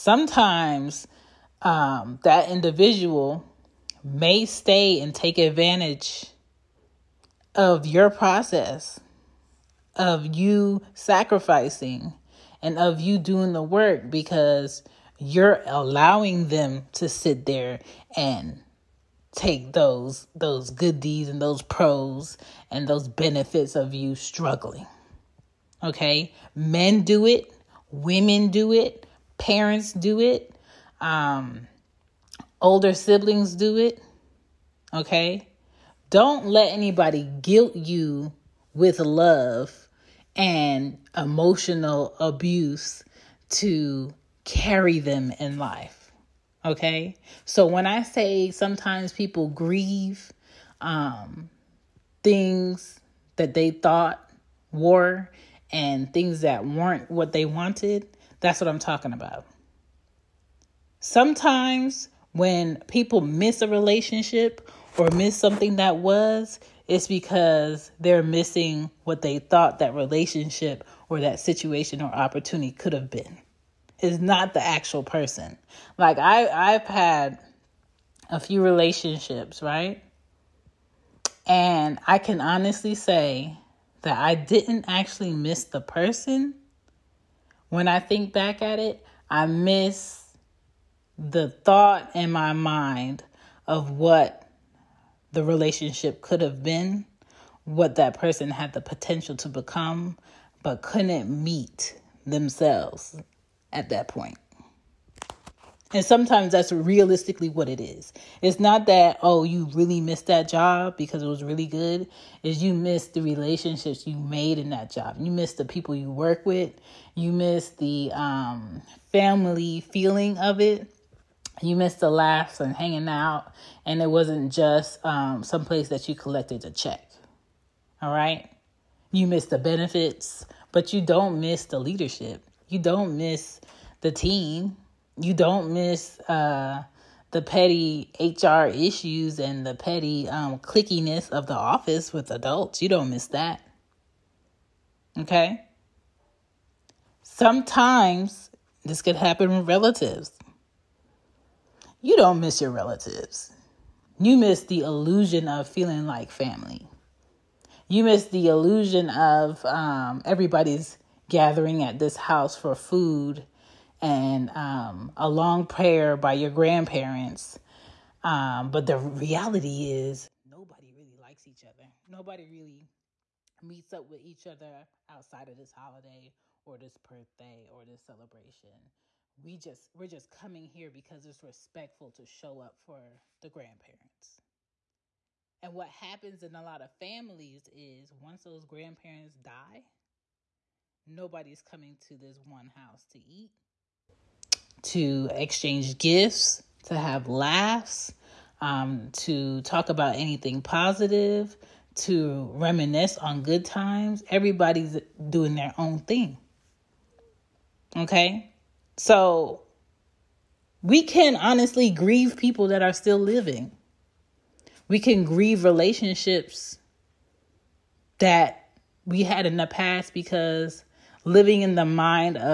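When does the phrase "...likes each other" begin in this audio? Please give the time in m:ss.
2:51.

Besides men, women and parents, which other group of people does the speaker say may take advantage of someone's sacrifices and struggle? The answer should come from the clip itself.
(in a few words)
Older siblings.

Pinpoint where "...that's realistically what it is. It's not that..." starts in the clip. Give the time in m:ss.
1:46.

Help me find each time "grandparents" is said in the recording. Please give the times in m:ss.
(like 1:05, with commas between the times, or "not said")
2:46, 3:03, 3:08.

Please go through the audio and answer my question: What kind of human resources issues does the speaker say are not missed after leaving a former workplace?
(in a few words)
Petty HR issues.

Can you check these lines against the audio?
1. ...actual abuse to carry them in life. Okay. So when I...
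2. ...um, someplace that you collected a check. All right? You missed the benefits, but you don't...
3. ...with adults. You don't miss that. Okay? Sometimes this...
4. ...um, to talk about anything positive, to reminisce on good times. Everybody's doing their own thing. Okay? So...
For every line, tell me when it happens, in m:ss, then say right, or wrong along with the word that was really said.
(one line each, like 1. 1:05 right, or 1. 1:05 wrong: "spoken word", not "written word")
1. 0:41 wrong: "emotional", not "actual"
2. 2:05 right
3. 2:22 right
4. 3:18 right.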